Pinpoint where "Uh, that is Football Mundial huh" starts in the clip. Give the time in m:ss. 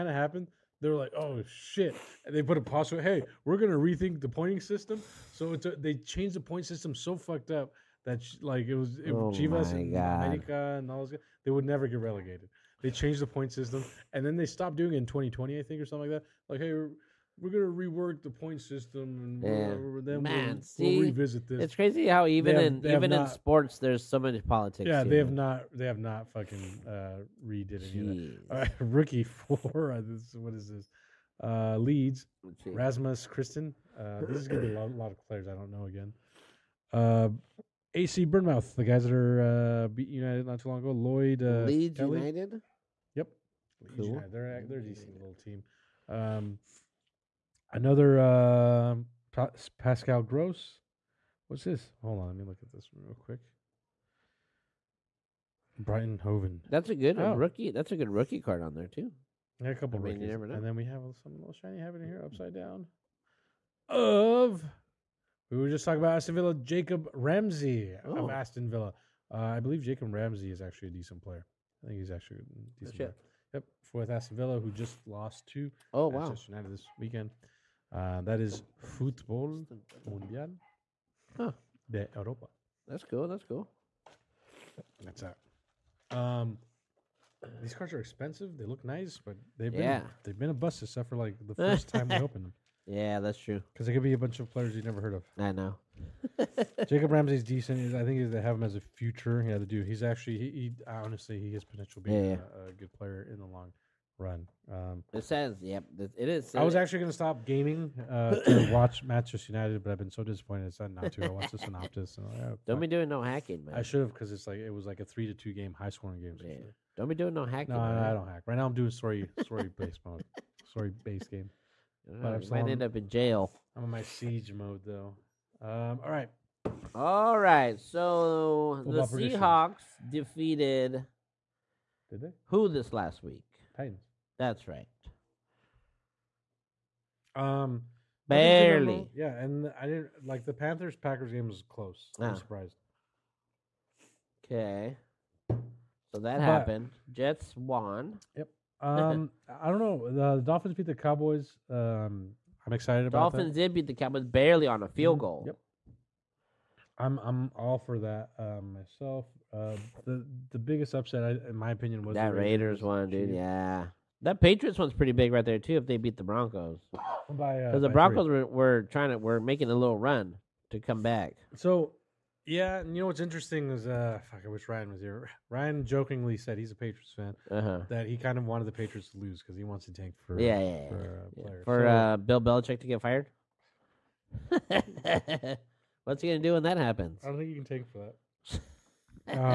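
1:17.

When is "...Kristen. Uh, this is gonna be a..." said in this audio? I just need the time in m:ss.
0:33.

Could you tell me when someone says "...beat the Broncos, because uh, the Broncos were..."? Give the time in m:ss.
2:45.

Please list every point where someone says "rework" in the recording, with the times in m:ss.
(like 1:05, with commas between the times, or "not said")
0:17.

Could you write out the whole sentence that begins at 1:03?
Of we were just talking about Aston Villa, Jacob Ramsey of oh.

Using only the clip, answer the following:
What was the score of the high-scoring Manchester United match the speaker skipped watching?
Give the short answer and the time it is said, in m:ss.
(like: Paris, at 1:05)
3 to 2, at 1:55.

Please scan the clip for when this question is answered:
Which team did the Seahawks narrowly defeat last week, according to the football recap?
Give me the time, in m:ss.
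2:13.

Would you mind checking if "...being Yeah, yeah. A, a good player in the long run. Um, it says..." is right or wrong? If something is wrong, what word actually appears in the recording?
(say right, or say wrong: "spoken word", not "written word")
right.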